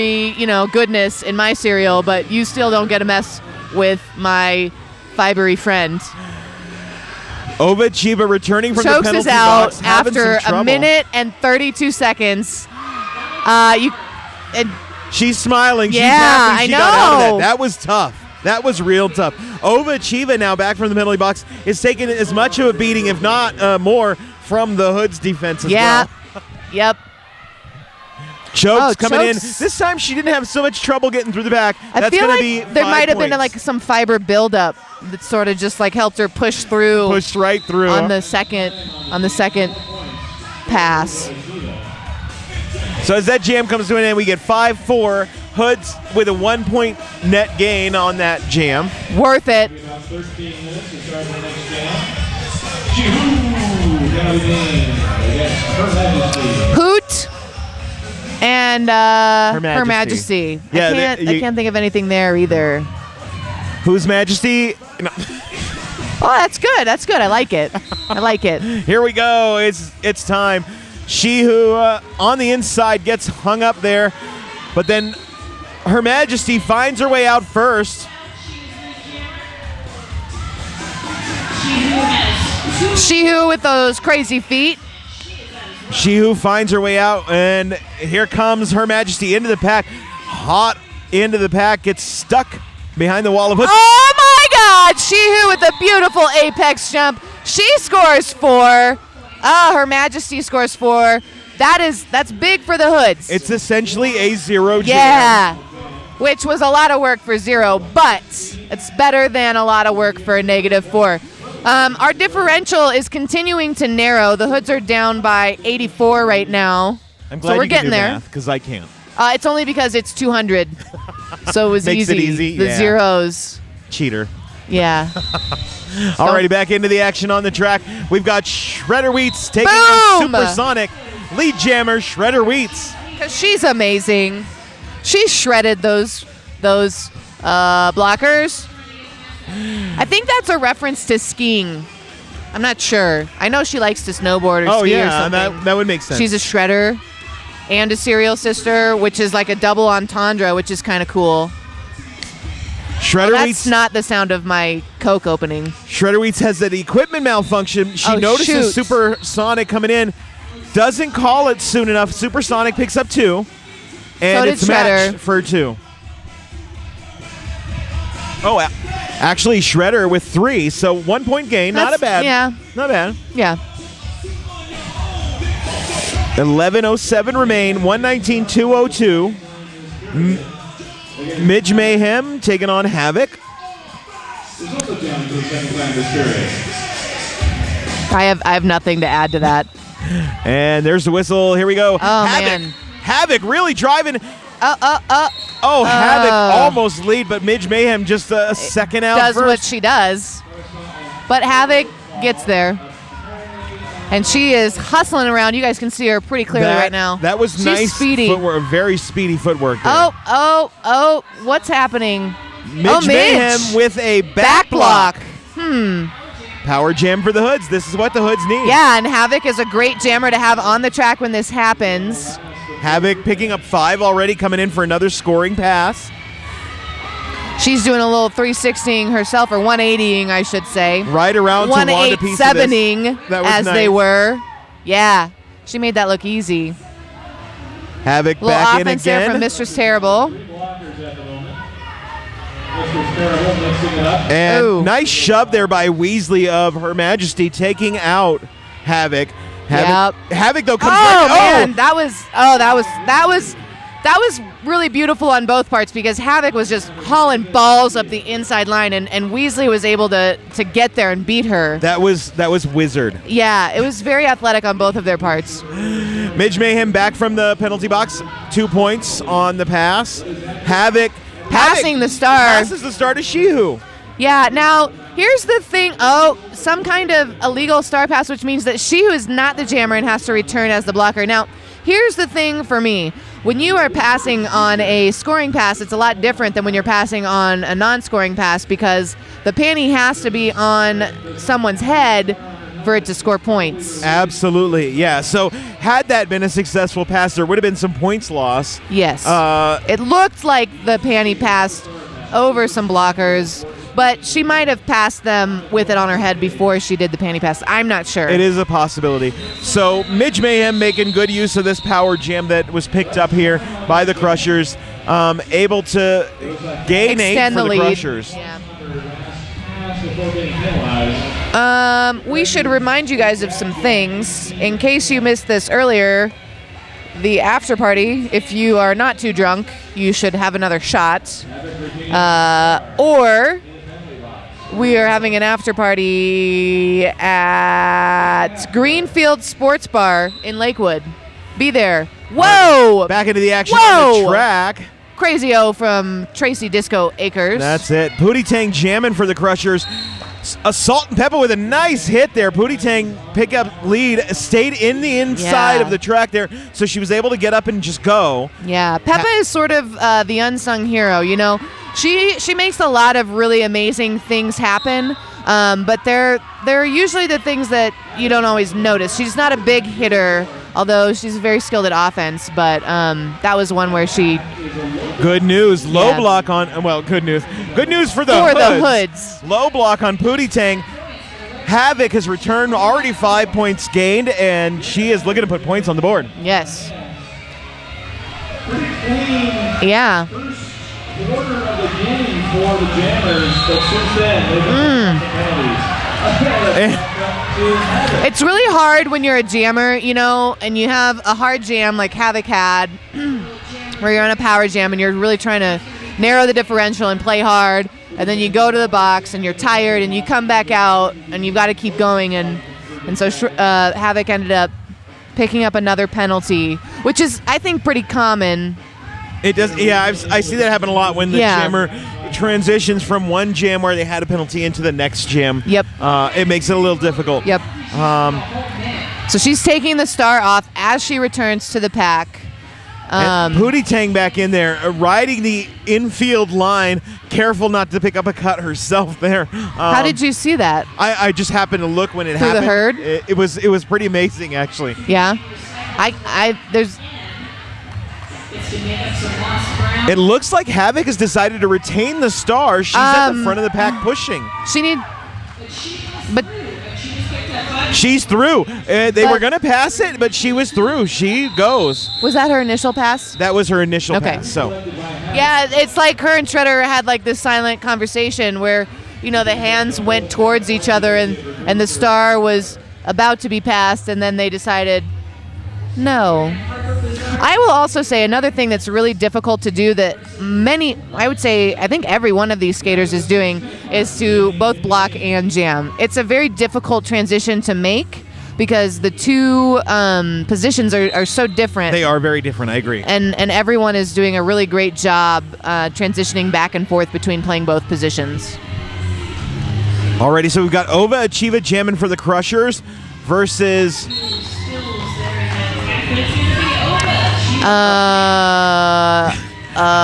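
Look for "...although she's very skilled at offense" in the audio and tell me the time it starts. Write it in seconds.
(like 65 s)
370 s.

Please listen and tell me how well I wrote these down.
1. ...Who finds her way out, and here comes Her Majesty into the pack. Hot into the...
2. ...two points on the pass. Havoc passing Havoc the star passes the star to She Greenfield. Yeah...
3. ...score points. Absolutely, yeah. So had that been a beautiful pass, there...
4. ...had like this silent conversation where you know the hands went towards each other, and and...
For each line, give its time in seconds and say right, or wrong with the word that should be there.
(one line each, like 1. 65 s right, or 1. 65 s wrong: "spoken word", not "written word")
1. 86 s right
2. 268 s wrong: "Who", not "Greenfield"
3. 293 s wrong: "successful", not "beautiful"
4. 466 s right.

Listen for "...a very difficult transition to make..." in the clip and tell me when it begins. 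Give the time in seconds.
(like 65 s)
486 s.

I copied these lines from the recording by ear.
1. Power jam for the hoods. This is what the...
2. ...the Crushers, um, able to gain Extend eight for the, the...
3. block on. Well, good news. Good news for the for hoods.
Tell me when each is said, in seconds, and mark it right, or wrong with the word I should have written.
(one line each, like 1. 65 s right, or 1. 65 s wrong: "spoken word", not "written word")
1. 216 s right
2. 314 s right
3. 376 s right.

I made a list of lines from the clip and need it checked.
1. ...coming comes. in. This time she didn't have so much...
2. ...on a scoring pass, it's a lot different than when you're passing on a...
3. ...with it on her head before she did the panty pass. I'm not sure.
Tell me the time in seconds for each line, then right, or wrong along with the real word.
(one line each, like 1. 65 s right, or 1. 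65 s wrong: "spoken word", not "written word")
1. 29 s wrong: "chokes", not "comes"
2. 284 s right
3. 305 s right.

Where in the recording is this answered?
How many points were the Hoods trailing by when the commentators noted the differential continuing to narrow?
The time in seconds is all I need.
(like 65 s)
115 s.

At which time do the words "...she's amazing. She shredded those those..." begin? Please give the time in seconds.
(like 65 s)
133 s.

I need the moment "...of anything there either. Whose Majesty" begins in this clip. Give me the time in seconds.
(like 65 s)
61 s.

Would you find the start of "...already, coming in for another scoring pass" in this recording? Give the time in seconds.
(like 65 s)
224 s.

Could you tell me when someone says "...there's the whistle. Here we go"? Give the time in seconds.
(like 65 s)
190 s.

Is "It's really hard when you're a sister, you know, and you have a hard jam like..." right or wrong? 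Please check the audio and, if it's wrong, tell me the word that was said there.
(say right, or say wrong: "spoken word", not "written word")
wrong: "jammer", not "sister".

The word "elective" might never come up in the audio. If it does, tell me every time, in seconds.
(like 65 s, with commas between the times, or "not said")
not said.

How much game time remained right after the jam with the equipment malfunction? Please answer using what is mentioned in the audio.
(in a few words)
11.07.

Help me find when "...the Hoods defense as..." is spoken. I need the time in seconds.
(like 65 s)
24 s.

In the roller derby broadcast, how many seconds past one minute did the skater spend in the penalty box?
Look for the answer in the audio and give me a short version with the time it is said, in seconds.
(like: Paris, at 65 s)
32, at 11 s.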